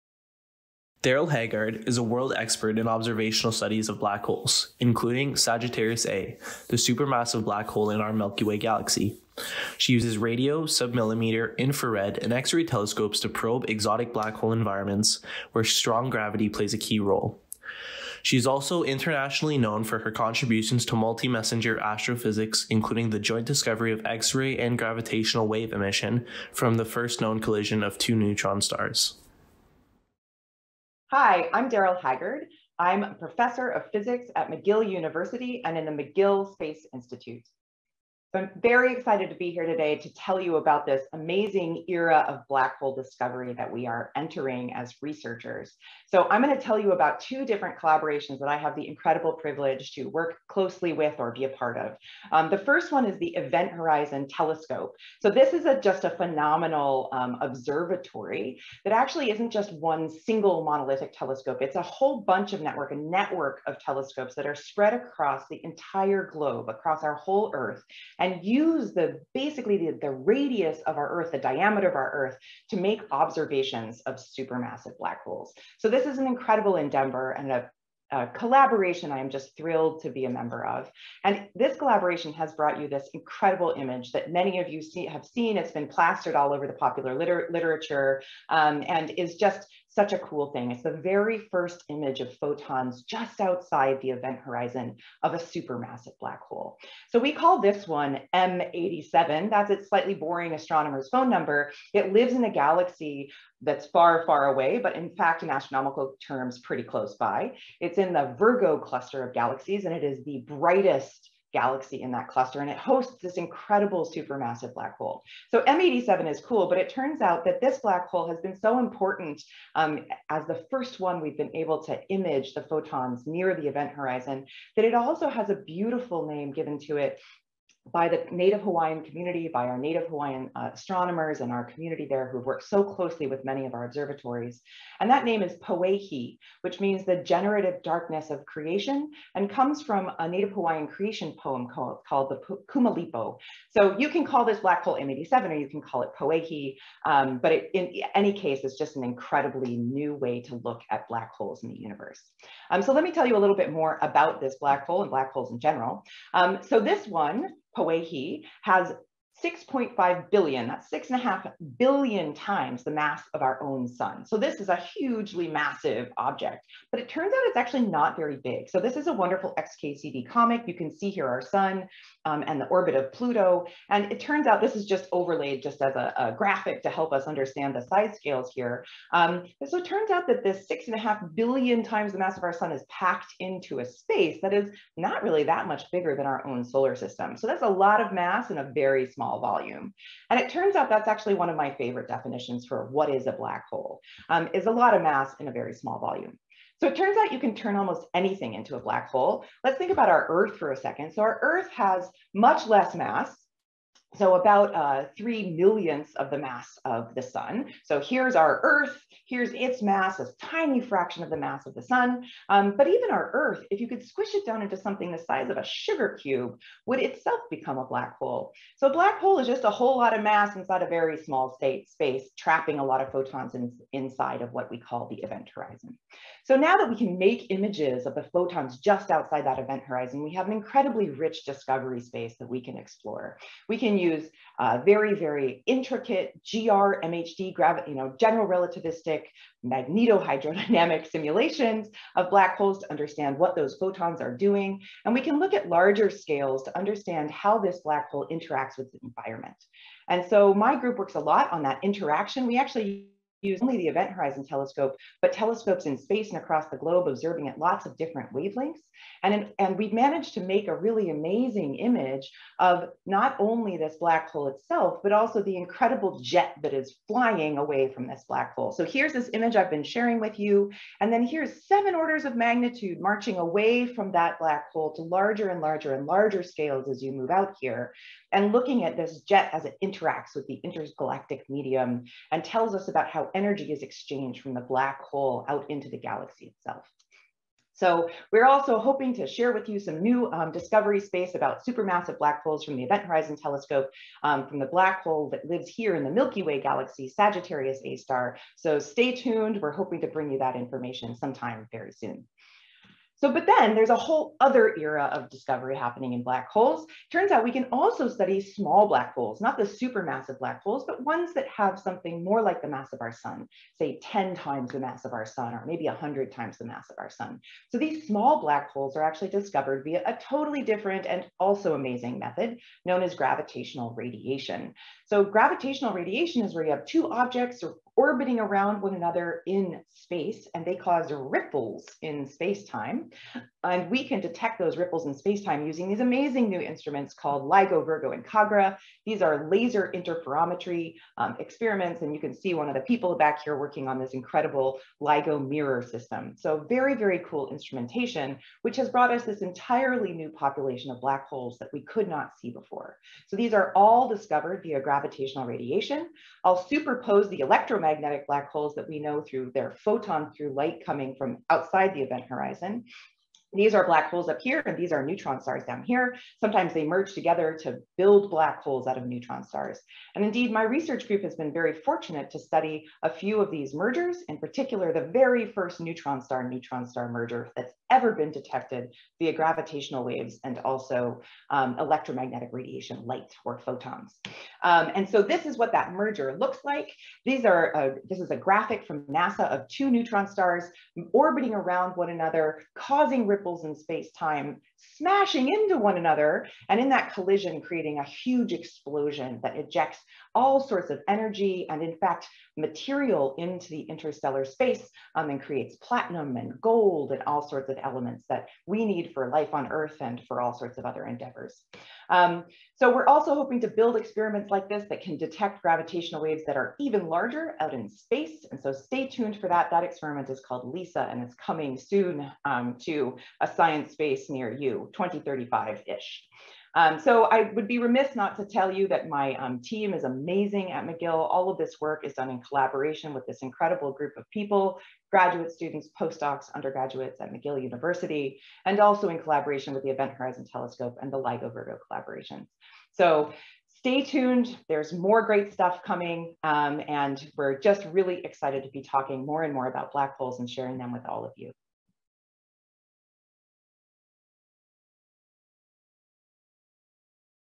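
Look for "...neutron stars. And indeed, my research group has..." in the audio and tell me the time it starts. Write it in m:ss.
6:09.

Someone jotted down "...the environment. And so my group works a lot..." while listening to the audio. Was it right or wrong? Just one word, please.
right.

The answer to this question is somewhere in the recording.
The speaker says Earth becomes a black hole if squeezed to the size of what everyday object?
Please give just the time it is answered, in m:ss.
3:35.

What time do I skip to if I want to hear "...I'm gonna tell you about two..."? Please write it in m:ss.
0:46.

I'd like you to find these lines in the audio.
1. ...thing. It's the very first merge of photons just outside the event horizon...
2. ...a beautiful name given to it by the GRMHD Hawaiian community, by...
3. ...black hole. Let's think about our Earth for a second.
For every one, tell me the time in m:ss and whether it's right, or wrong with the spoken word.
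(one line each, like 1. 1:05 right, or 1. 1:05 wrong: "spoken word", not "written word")
1. 1:30 wrong: "image", not "merge"
2. 2:05 wrong: "Native", not "GRMHD"
3. 3:18 right.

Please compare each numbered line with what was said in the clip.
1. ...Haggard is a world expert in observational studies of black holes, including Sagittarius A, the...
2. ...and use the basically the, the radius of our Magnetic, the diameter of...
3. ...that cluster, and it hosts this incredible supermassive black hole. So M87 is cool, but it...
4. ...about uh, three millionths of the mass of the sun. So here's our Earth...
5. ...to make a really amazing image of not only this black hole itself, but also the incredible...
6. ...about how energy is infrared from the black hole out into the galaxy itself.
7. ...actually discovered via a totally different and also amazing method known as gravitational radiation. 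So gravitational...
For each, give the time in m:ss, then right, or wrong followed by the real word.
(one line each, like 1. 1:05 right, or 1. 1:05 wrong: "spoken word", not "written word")
1. 0:01 right
2. 1:08 wrong: "Earth", not "Magnetic"
3. 1:52 right
4. 3:24 right
5. 4:20 right
6. 4:42 wrong: "exchanged", not "infrared"
7. 5:19 right.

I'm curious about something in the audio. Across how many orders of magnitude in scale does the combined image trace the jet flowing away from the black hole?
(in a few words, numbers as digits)
7.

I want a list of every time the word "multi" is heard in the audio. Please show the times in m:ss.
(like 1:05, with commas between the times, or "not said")
0:20.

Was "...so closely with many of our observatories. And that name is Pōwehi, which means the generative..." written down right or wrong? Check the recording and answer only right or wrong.
right.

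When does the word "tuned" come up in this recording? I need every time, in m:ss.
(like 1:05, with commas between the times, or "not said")
4:59, 6:59, 7:24.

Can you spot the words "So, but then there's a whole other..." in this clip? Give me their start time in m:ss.
5:03.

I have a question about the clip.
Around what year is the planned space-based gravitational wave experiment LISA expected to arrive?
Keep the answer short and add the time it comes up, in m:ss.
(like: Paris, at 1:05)
2035, at 7:04.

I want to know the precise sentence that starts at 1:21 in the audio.
And this collaboration has brought you this incredible image that many of you see, have seen.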